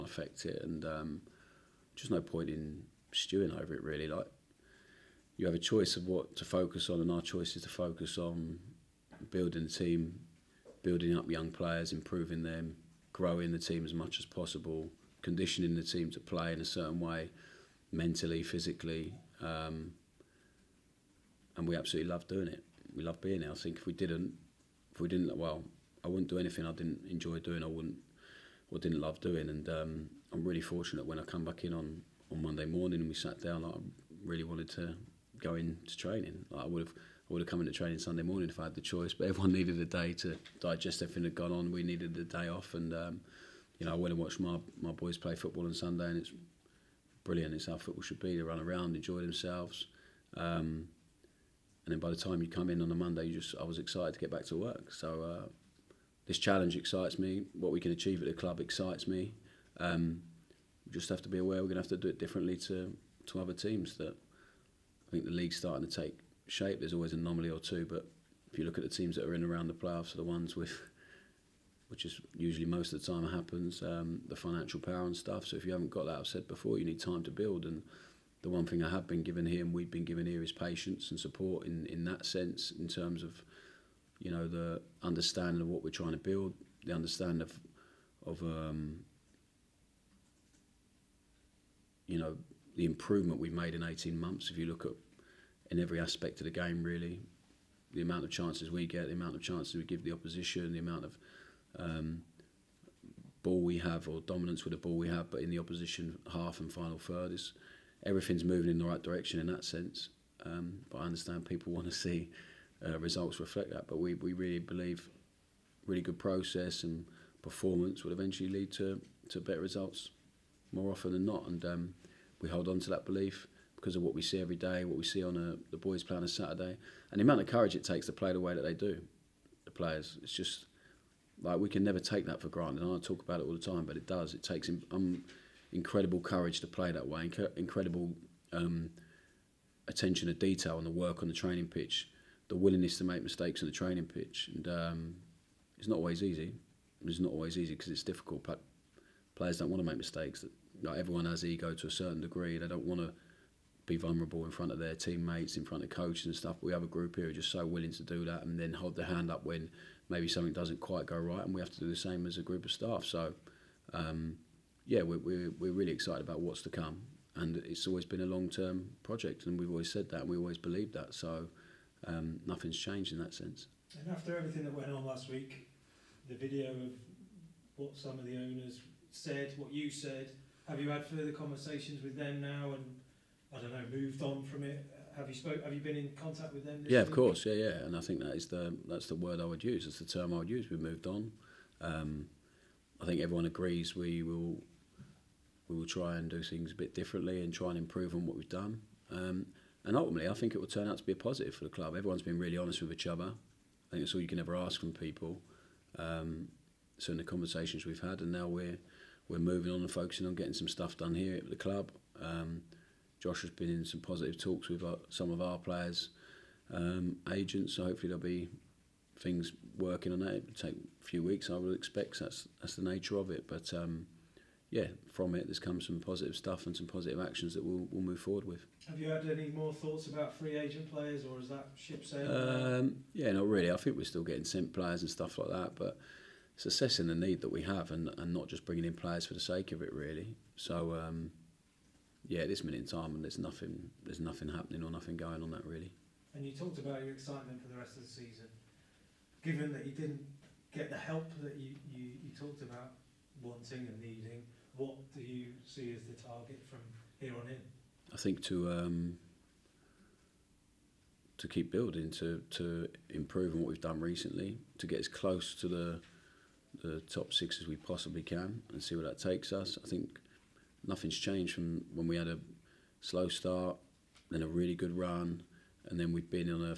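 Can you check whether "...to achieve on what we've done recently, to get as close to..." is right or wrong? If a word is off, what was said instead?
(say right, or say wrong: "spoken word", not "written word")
wrong: "improve", not "achieve".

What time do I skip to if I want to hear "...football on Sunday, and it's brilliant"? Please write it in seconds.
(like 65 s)
45 s.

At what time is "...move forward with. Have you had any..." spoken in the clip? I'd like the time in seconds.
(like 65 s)
228 s.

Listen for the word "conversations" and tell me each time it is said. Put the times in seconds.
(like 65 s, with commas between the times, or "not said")
181 s, 207 s.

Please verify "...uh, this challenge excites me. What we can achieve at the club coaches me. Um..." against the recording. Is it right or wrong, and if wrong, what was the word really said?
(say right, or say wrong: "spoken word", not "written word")
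wrong: "excites", not "coaches".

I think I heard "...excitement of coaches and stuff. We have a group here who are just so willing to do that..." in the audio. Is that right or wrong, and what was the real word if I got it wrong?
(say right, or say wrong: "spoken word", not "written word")
wrong: "front", not "excitement".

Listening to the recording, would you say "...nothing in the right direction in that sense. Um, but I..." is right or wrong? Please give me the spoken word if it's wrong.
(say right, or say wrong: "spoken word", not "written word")
wrong: "moving", not "nothing".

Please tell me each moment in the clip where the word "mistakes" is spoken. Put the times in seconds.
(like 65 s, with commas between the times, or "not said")
143 s, 149 s.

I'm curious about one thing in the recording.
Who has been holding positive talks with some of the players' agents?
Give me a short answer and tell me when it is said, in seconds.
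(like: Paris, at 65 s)
Josh, at 213 s.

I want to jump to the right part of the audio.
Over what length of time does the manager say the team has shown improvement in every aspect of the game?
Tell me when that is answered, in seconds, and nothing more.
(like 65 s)
93 s.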